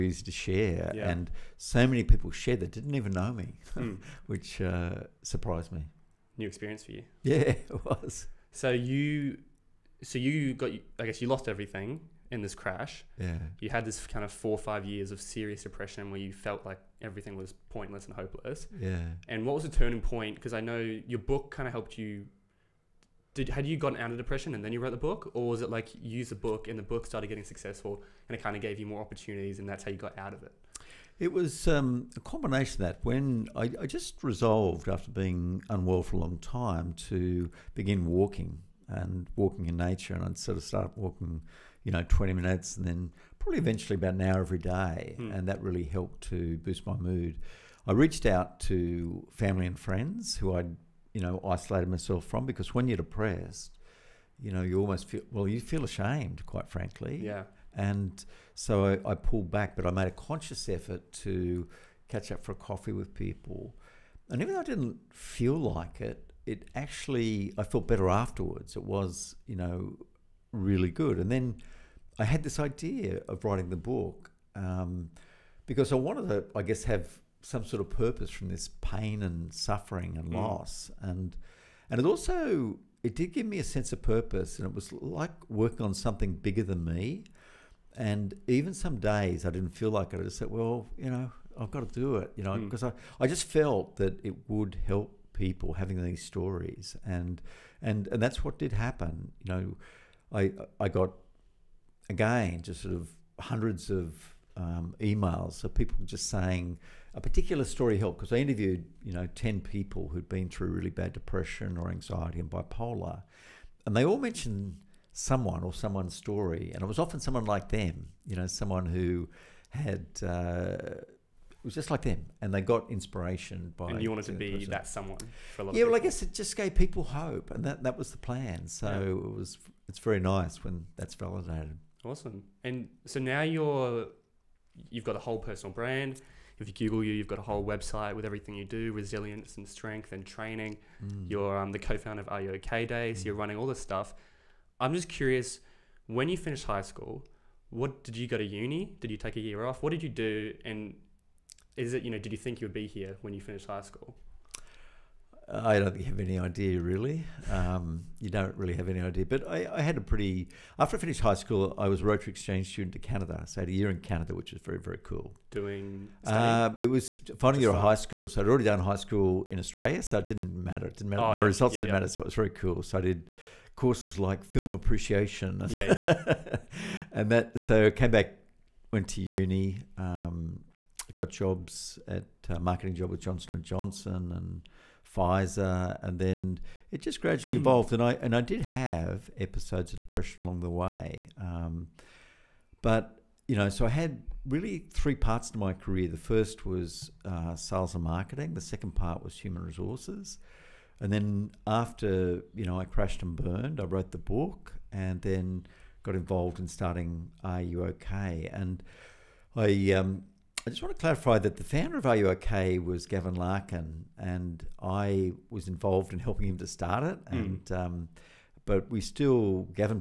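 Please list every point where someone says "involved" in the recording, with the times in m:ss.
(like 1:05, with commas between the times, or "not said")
3:26, 3:35.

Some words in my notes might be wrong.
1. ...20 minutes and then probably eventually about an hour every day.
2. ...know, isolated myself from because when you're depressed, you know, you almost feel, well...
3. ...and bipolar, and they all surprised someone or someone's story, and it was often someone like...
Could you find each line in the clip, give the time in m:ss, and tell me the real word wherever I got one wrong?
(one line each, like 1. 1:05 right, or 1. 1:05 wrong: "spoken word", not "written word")
1. 0:42 right
2. 0:51 right
3. 1:52 wrong: "mentioned", not "surprised".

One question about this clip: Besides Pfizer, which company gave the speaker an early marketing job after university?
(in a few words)
Johnson and Johnson.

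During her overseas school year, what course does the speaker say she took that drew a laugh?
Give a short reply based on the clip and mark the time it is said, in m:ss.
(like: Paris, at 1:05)
Film appreciation, at 2:54.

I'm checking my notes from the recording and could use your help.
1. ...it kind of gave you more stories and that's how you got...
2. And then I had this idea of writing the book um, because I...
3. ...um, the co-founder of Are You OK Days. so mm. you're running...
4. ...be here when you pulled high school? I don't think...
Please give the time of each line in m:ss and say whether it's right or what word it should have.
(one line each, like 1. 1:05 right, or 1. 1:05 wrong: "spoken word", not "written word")
1. 0:28 wrong: "opportunities", not "stories"
2. 1:11 right
3. 2:21 right
4. 2:32 wrong: "finished", not "pulled".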